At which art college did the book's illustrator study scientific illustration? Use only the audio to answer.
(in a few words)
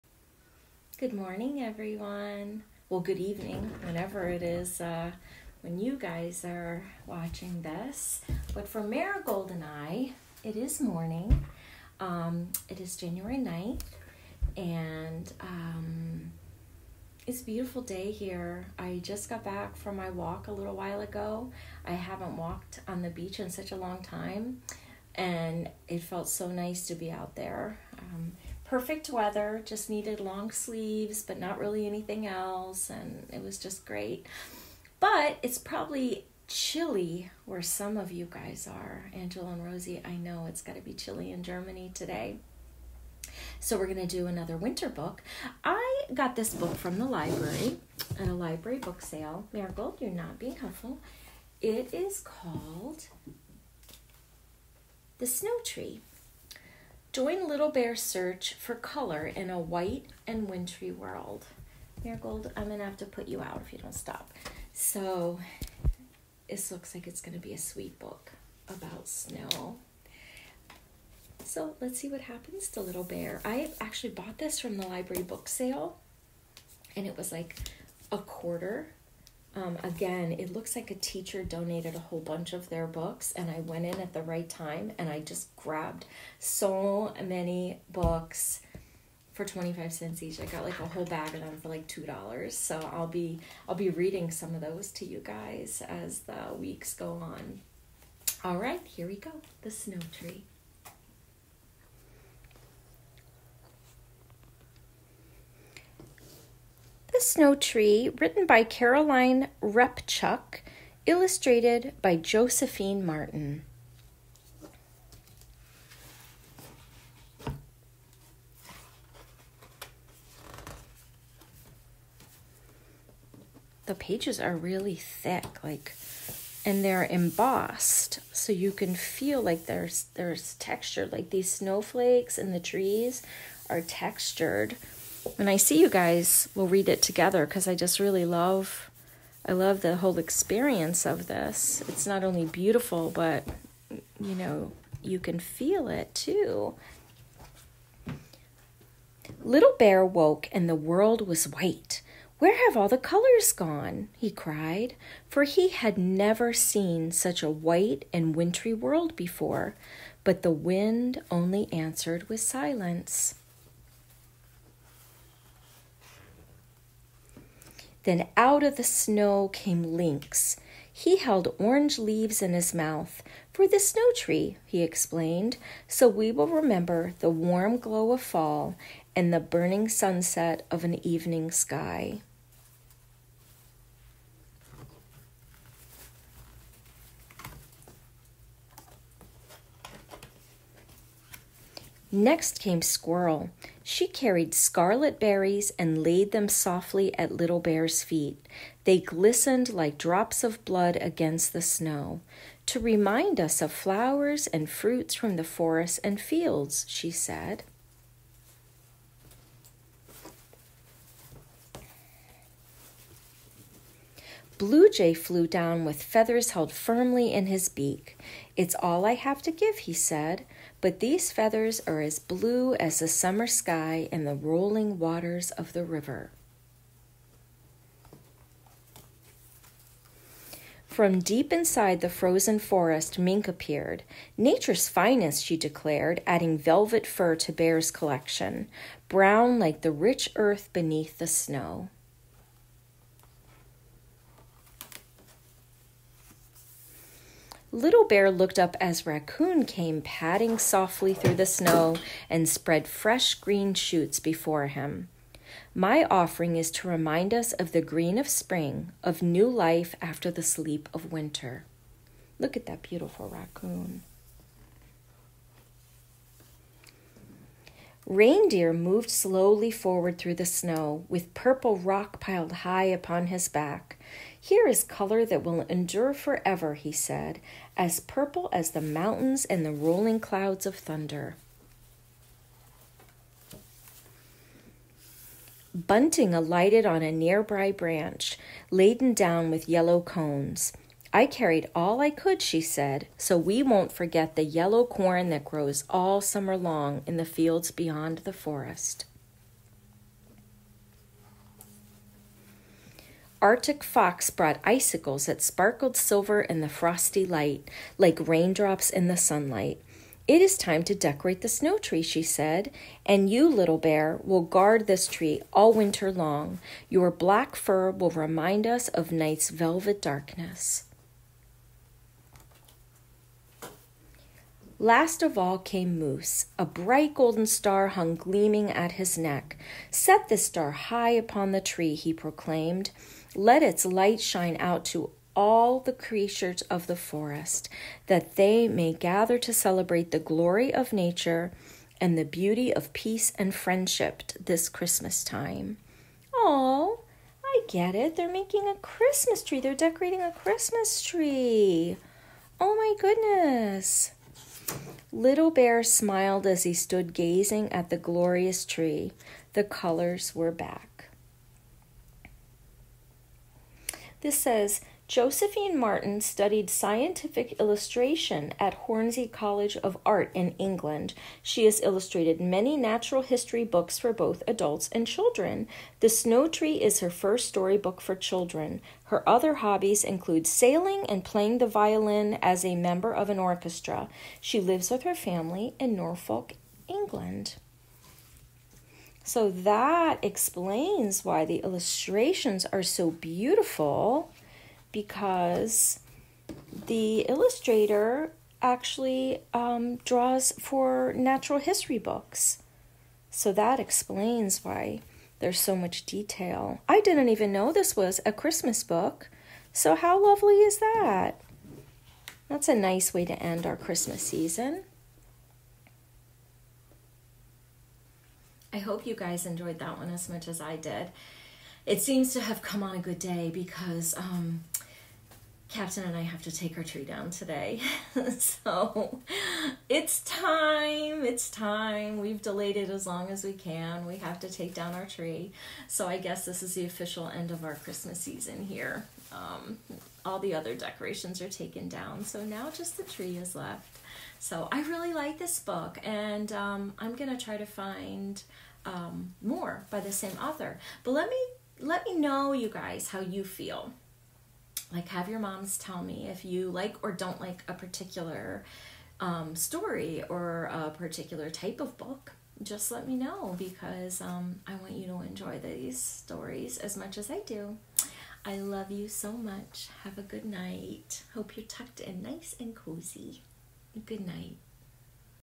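Hornsey College of Art.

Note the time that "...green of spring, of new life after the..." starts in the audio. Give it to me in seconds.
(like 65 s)
257 s.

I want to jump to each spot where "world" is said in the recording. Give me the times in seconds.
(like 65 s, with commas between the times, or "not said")
60 s, 150 s, 158 s.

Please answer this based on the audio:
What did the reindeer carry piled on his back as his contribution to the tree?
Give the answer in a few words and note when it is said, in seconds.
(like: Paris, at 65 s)
Purple rock, at 271 s.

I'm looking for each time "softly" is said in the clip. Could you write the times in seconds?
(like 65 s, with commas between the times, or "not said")
196 s, 250 s.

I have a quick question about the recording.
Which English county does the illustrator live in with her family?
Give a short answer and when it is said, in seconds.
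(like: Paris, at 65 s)
Norfolk, at 385 s.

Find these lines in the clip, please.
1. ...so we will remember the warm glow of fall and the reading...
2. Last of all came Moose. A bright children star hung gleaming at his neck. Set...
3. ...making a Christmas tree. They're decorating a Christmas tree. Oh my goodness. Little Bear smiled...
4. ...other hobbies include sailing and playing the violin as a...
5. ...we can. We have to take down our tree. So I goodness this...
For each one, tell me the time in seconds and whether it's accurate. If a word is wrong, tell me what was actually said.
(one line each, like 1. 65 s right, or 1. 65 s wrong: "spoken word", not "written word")
1. 175 s wrong: "burning", not "reading"
2. 324 s wrong: "golden", not "children"
3. 348 s right
4. 379 s right
5. 433 s wrong: "guess", not "goodness".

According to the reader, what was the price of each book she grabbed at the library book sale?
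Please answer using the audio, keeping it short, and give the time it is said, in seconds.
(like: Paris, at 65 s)
25 cents, at 89 s.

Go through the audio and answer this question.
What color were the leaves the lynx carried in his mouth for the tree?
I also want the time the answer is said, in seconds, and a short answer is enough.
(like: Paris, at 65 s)
Orange, at 171 s.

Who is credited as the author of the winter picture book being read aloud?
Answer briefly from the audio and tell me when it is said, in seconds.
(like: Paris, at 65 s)
Caroline Repchuk, at 108 s.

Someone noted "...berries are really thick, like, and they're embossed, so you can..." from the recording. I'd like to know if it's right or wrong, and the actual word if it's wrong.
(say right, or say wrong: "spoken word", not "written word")
wrong: "pages", not "berries".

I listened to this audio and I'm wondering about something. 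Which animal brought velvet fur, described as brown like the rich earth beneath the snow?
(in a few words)
Mink.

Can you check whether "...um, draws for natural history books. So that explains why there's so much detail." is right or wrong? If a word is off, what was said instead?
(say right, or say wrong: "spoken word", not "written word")
right.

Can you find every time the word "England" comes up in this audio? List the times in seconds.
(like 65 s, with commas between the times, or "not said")
370 s, 386 s.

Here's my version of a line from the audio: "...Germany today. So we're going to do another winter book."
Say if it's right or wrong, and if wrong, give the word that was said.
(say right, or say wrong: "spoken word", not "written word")
right.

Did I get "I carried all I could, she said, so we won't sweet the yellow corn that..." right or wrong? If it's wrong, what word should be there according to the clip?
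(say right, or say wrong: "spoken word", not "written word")
wrong: "forget", not "sweet".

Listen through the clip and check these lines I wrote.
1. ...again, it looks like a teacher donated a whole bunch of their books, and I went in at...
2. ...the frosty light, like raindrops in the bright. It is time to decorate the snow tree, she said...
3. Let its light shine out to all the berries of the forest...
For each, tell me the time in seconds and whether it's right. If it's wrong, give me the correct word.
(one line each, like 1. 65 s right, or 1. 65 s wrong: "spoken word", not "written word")
1. 79 s right
2. 306 s wrong: "sunlight", not "bright"
3. 333 s wrong: "creatures", not "berries".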